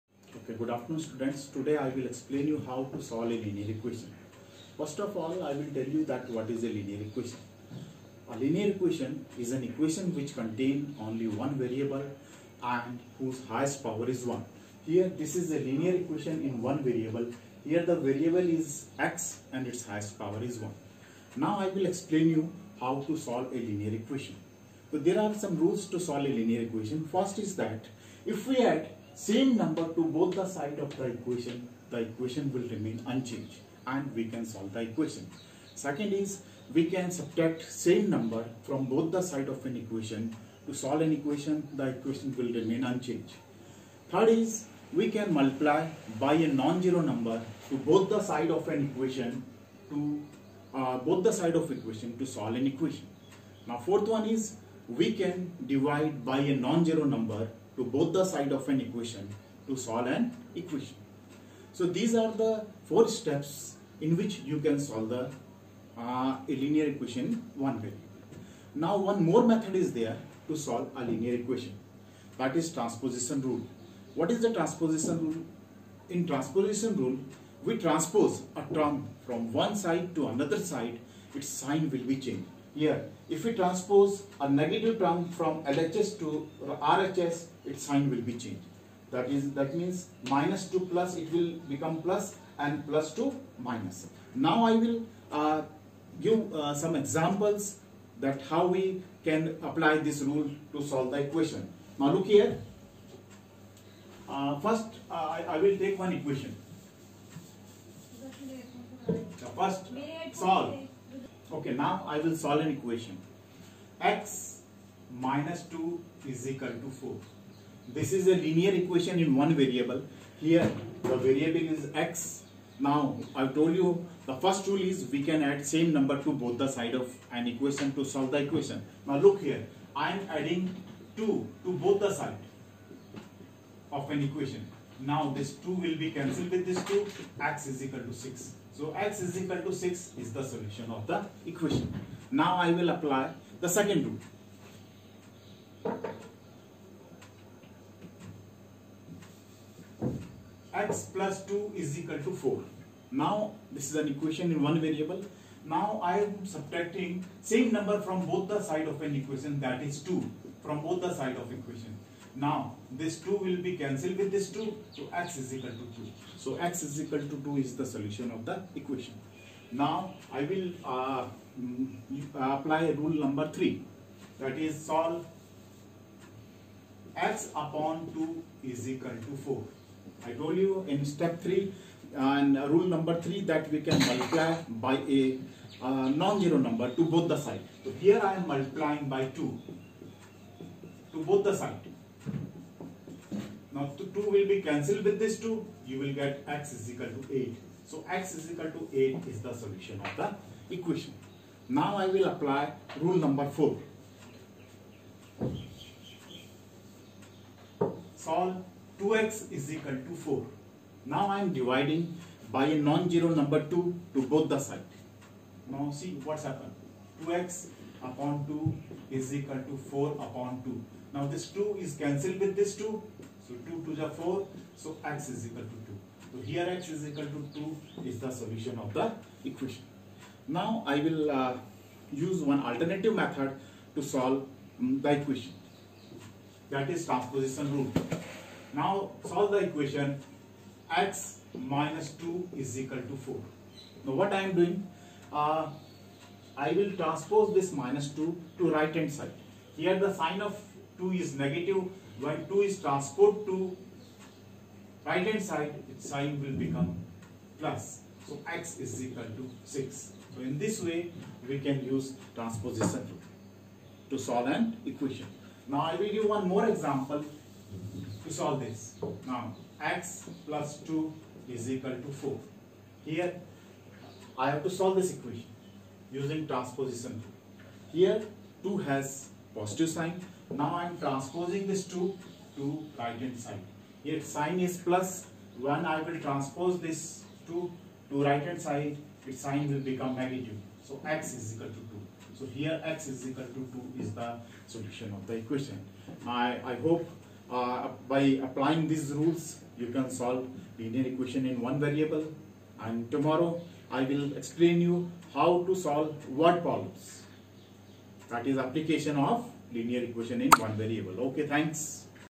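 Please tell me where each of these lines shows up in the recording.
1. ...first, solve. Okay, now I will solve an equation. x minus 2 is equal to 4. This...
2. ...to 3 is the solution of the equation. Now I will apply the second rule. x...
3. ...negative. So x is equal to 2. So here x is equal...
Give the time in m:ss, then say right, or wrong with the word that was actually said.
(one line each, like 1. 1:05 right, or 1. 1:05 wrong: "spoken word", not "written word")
1. 1:49 right
2. 2:19 wrong: "6", not "3"
3. 4:50 right.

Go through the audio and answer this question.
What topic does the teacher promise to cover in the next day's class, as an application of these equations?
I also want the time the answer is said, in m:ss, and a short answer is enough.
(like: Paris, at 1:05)
Word problems, at 5:06.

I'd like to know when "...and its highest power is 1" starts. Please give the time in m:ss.
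0:19.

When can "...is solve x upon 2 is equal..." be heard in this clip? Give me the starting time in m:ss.
2:54.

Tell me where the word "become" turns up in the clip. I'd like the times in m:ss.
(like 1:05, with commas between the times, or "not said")
1:31, 4:16, 4:49.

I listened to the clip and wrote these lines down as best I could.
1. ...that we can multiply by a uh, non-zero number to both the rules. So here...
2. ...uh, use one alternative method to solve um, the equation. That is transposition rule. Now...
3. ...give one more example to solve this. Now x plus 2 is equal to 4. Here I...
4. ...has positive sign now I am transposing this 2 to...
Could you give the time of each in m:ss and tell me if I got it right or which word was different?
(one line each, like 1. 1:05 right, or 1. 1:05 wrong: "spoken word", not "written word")
1. 3:03 wrong: "sides", not "rules"
2. 3:51 right
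3. 4:26 right
4. 4:38 right.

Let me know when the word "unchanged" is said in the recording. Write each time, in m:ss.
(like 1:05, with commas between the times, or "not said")
0:33, 0:42.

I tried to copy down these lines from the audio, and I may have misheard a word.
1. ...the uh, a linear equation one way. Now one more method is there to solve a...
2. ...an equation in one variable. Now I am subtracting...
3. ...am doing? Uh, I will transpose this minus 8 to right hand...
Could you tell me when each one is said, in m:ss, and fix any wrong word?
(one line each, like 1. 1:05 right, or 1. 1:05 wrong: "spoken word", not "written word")
1. 1:05 right
2. 2:33 right
3. 4:04 wrong: "2", not "8".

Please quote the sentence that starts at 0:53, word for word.
Now fourth one is we can divide by a non-zero number to both the side of an equation to solve an equation.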